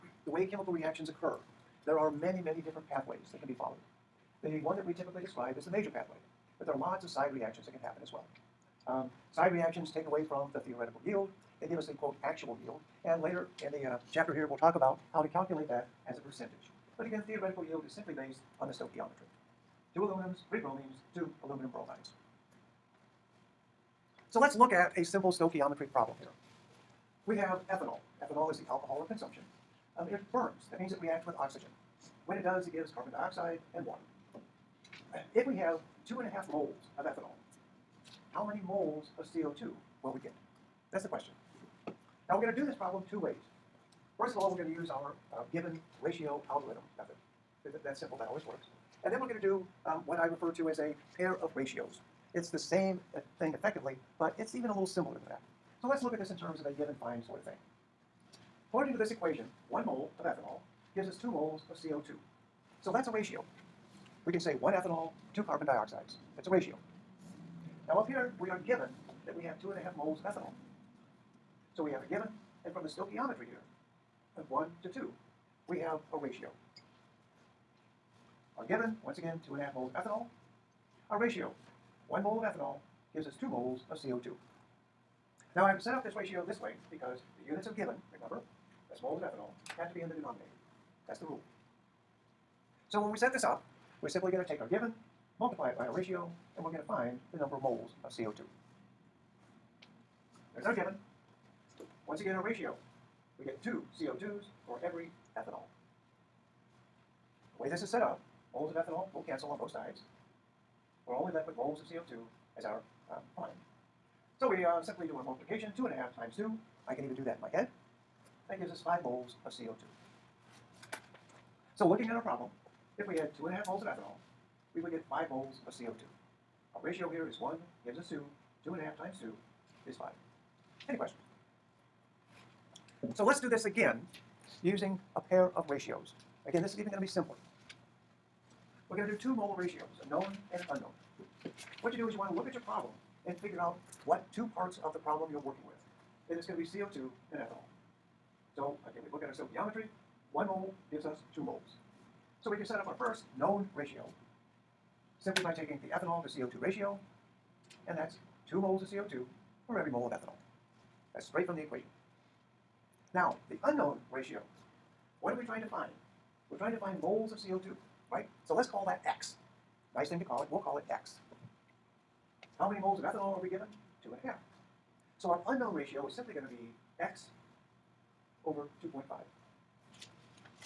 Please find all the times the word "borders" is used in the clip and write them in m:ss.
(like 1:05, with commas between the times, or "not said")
not said.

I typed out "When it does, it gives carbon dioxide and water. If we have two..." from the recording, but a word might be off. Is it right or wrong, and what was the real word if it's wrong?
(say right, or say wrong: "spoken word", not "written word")
right.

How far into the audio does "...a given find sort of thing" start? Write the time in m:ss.
0:56.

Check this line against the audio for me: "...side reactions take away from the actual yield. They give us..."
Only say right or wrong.
wrong.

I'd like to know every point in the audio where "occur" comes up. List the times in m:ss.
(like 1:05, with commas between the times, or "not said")
0:01.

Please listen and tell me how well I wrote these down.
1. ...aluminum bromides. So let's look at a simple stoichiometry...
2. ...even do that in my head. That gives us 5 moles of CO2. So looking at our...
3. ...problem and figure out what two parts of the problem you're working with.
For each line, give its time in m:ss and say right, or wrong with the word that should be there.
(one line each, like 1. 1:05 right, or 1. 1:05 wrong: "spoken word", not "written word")
1. 0:21 right
2. 1:57 right
3. 2:22 right.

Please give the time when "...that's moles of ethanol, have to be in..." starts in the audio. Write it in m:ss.
1:28.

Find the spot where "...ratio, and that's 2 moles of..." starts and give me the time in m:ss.
2:36.